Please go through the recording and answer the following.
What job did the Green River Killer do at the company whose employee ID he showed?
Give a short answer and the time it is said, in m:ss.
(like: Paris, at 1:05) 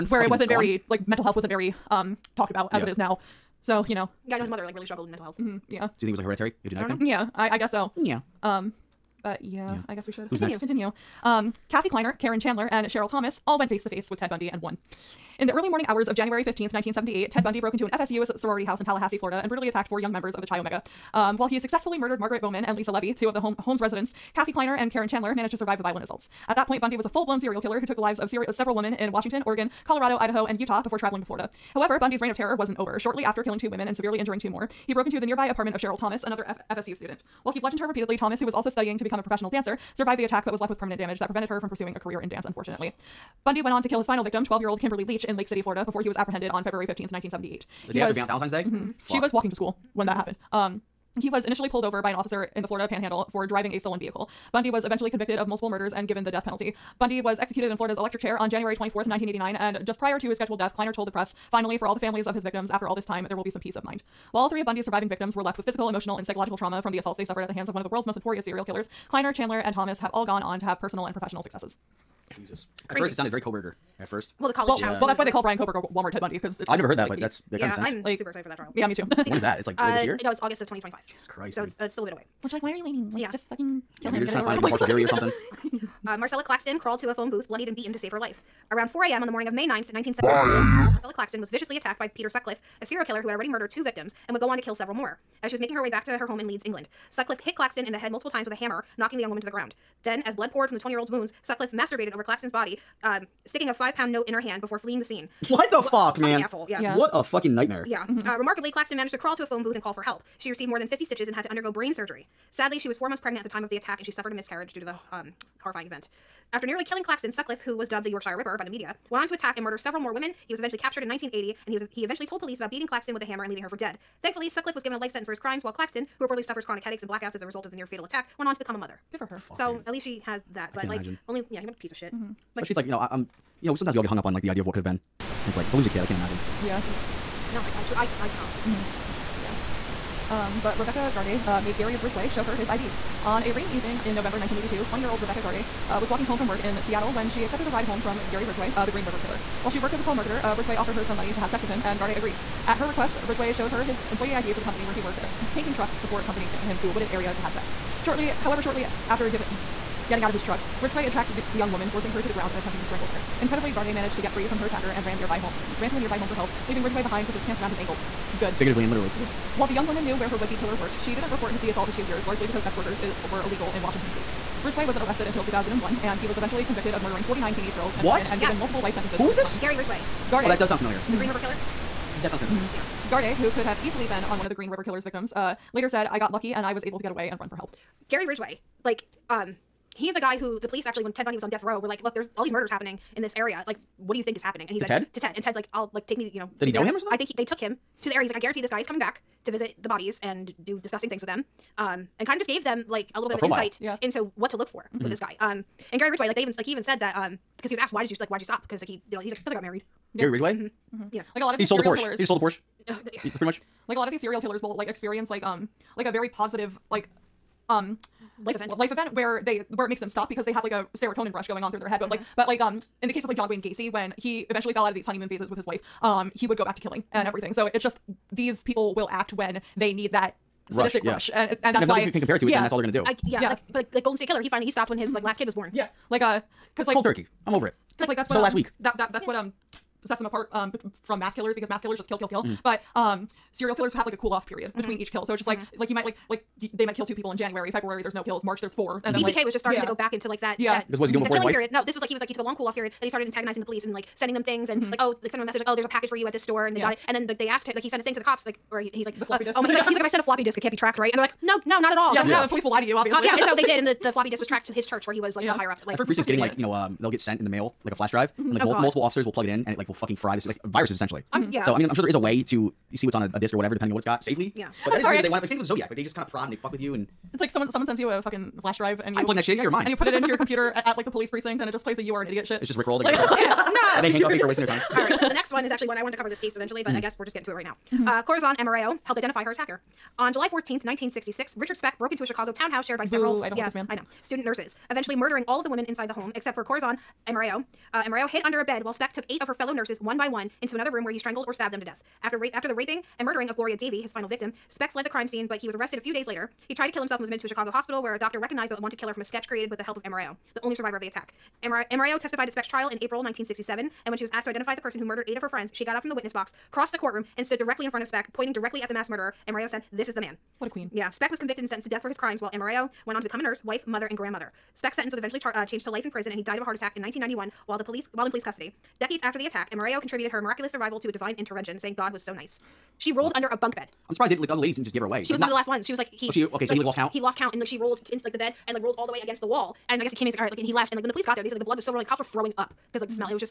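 painting trucks, at 2:35.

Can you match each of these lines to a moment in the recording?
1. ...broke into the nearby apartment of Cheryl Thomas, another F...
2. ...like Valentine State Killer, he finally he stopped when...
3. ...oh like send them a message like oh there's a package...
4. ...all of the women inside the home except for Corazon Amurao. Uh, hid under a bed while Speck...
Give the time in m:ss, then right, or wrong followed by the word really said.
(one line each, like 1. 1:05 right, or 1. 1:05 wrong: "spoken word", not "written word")
1. 0:34 right
2. 3:53 wrong: "Golden", not "Valentine"
3. 4:15 right
4. 4:55 right.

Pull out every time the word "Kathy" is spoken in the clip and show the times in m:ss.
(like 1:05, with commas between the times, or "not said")
0:11, 0:24.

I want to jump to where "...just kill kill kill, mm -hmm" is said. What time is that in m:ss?
4:01.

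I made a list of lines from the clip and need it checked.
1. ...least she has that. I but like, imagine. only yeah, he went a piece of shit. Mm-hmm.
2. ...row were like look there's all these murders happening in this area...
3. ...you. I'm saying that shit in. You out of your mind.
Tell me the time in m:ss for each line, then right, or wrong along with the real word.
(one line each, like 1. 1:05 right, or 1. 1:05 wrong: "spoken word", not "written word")
1. 2:09 right
2. 3:11 right
3. 4:39 wrong: "plugging", not "saying".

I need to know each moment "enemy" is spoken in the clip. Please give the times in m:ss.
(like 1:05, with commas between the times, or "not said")
not said.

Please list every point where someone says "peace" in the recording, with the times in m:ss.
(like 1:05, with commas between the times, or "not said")
1:03.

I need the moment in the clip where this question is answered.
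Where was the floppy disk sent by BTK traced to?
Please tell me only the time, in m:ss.
4:24.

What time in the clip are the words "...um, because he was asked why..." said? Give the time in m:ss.
3:27.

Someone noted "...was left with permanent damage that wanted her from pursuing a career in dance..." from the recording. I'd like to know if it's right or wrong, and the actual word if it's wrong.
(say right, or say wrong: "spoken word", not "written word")
wrong: "prevented", not "wanted".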